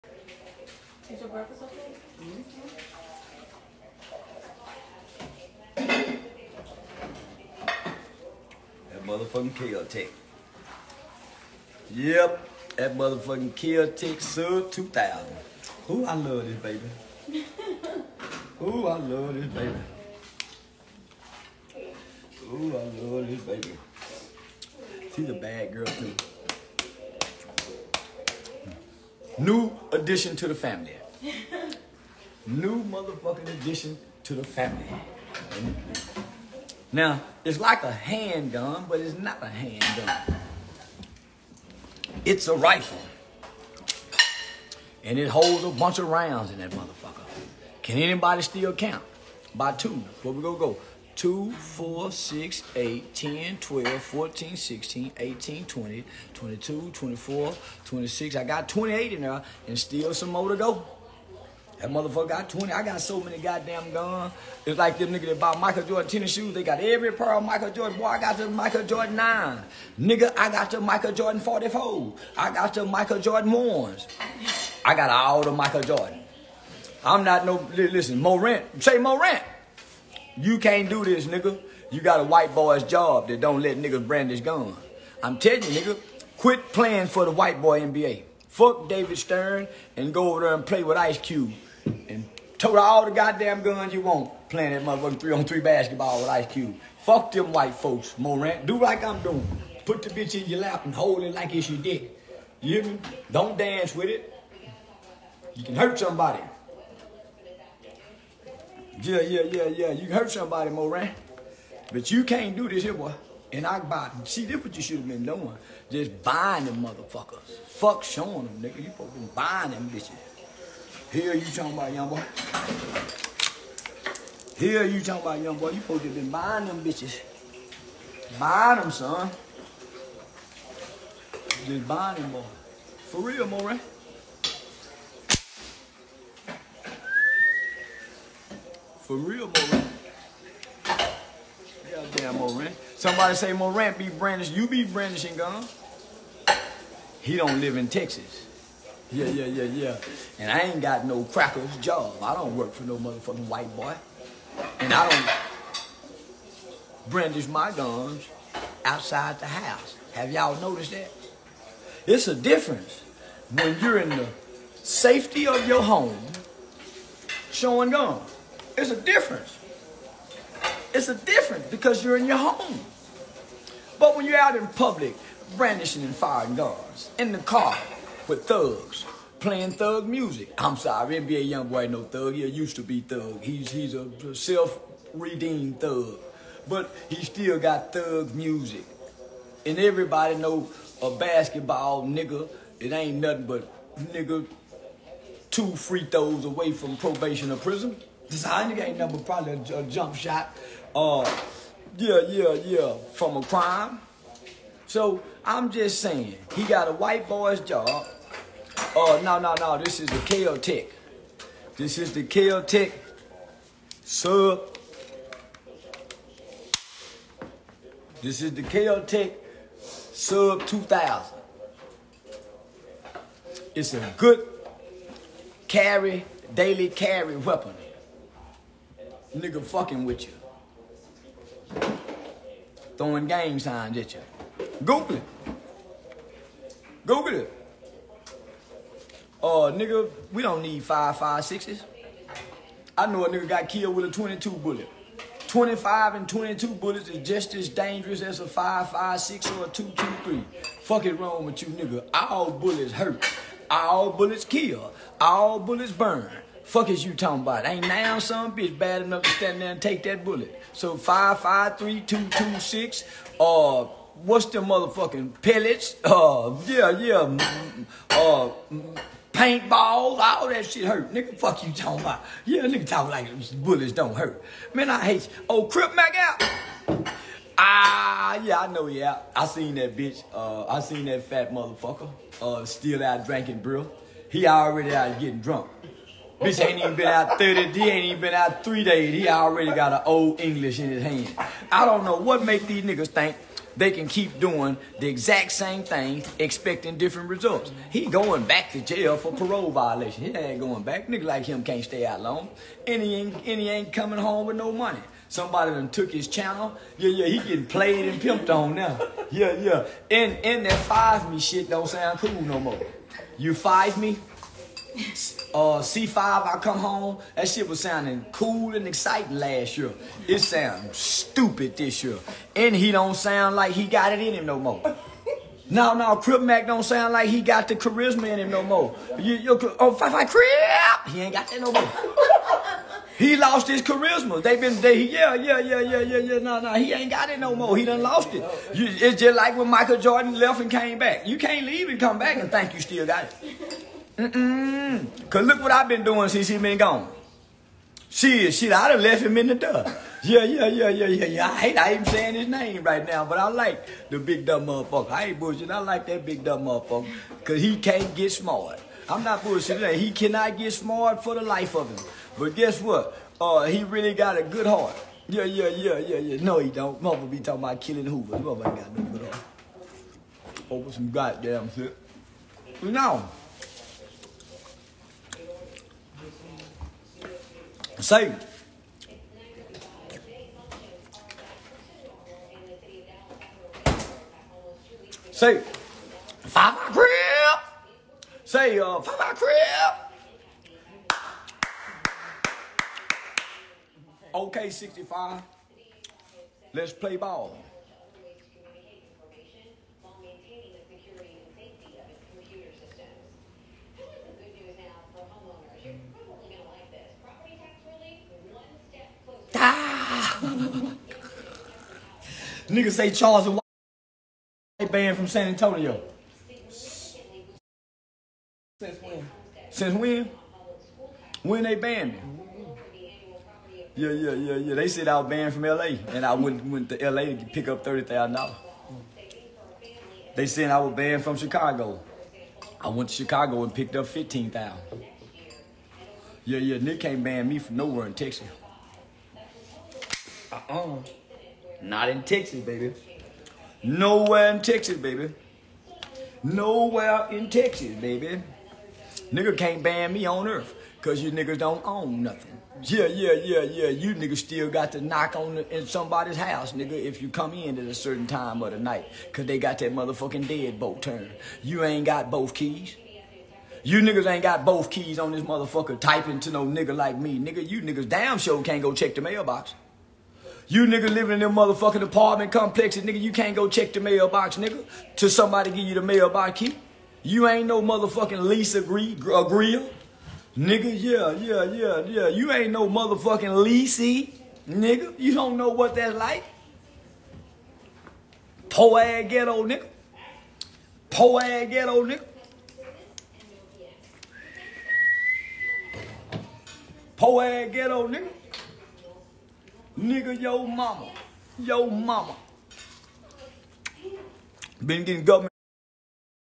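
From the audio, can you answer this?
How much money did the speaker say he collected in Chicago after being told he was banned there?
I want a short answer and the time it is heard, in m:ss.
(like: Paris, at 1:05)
15000, at 7:14.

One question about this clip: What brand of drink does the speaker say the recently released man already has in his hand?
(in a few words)
Old English.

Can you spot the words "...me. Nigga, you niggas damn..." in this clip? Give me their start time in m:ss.
7:47.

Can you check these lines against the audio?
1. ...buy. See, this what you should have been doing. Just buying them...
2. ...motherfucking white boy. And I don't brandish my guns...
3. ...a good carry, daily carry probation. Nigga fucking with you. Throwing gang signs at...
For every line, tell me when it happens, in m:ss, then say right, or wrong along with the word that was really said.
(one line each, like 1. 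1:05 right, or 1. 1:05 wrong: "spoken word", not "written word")
1. 1:53 right
2. 2:32 right
3. 3:43 wrong: "weapon", not "probation".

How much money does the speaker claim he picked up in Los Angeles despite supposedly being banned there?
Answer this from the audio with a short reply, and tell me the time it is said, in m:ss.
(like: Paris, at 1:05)
$30,000, at 7:07.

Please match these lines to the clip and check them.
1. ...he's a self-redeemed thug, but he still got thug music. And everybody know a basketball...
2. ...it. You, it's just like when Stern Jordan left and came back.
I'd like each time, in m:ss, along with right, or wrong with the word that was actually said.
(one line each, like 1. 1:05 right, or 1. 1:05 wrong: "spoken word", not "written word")
1. 3:03 right
2. 5:38 wrong: "Michael", not "Stern".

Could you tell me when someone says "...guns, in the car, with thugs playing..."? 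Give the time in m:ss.
2:56.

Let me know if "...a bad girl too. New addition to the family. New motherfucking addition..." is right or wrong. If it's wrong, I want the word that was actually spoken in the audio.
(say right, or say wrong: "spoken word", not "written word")
right.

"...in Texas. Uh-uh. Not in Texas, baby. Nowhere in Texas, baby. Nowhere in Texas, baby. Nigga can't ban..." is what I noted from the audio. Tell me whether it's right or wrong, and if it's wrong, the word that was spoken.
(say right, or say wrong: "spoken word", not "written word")
right.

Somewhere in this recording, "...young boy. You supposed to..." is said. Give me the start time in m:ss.
2:05.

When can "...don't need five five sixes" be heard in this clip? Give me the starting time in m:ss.
4:00.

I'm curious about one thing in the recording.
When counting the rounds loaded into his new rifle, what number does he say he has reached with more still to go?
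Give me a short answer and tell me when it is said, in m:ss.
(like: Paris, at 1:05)
28, at 0:58.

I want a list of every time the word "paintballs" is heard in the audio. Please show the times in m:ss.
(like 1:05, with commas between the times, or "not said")
4:29.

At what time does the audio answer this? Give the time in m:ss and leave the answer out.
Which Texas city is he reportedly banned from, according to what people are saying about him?
6:55.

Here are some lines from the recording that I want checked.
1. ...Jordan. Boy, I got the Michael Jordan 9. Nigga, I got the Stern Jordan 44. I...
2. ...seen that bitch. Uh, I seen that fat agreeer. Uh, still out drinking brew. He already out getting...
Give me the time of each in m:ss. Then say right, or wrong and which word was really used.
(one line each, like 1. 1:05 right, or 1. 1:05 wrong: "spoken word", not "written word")
1. 1:07 wrong: "Michael", not "Stern"
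2. 4:39 wrong: "motherfucker", not "agreeer".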